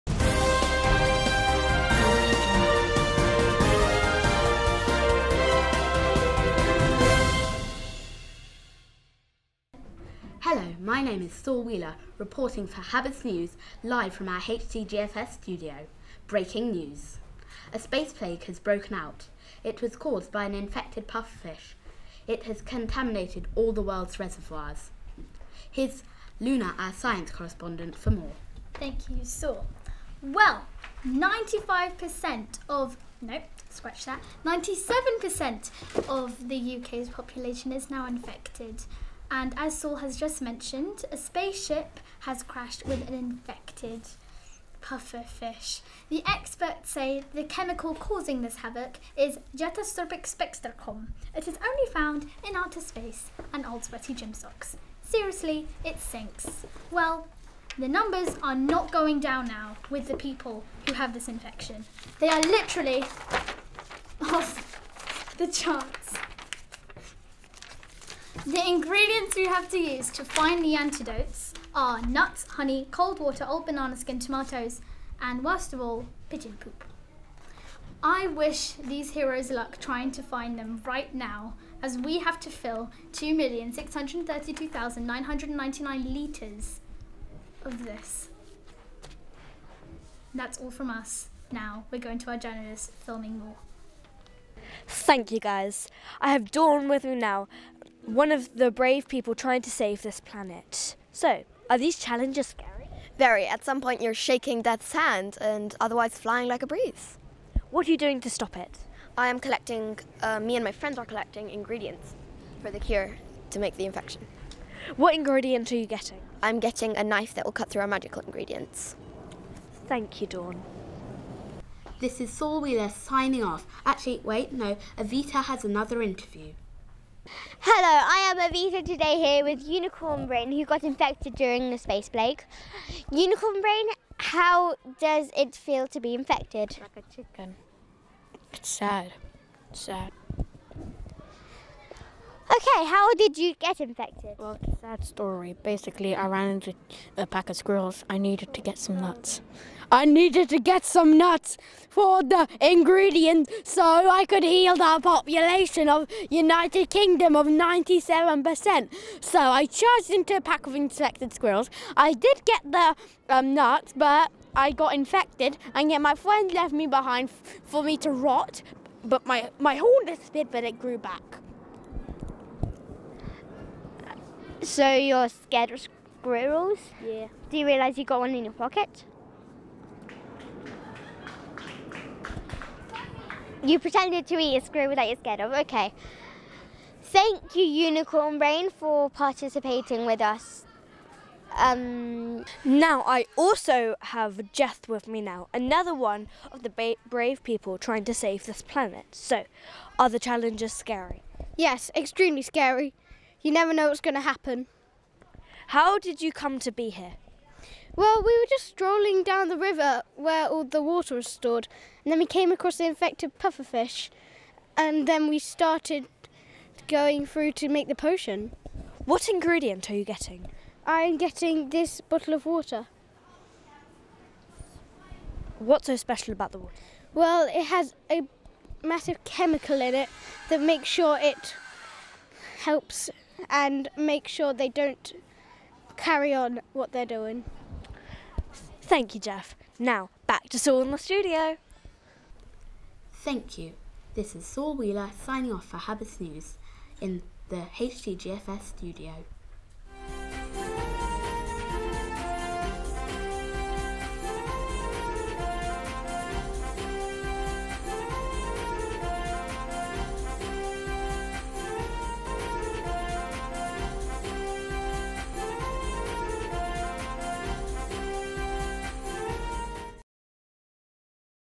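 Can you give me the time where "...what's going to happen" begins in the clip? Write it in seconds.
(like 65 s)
203 s.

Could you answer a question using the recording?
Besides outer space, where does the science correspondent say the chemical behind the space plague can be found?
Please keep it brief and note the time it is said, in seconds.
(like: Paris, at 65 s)
old sweaty gym socks, at 53 s.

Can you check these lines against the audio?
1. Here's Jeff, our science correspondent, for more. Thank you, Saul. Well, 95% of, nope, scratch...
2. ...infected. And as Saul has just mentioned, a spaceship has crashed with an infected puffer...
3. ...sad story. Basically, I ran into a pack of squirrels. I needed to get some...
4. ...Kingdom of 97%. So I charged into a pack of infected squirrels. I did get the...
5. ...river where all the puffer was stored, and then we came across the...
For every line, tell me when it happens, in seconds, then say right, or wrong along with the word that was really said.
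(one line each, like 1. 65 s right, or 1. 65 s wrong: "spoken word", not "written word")
1. 25 s wrong: "Luna", not "Jeff"
2. 38 s right
3. 144 s right
4. 156 s right
5. 209 s wrong: "water", not "puffer".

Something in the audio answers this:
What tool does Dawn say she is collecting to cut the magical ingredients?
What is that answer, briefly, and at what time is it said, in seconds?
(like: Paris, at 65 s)
a knife, at 116 s.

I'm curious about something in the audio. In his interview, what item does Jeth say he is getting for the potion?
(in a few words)
bottle of water.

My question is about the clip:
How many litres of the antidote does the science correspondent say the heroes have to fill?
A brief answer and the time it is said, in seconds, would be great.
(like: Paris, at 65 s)
2,632,999 litres, at 83 s.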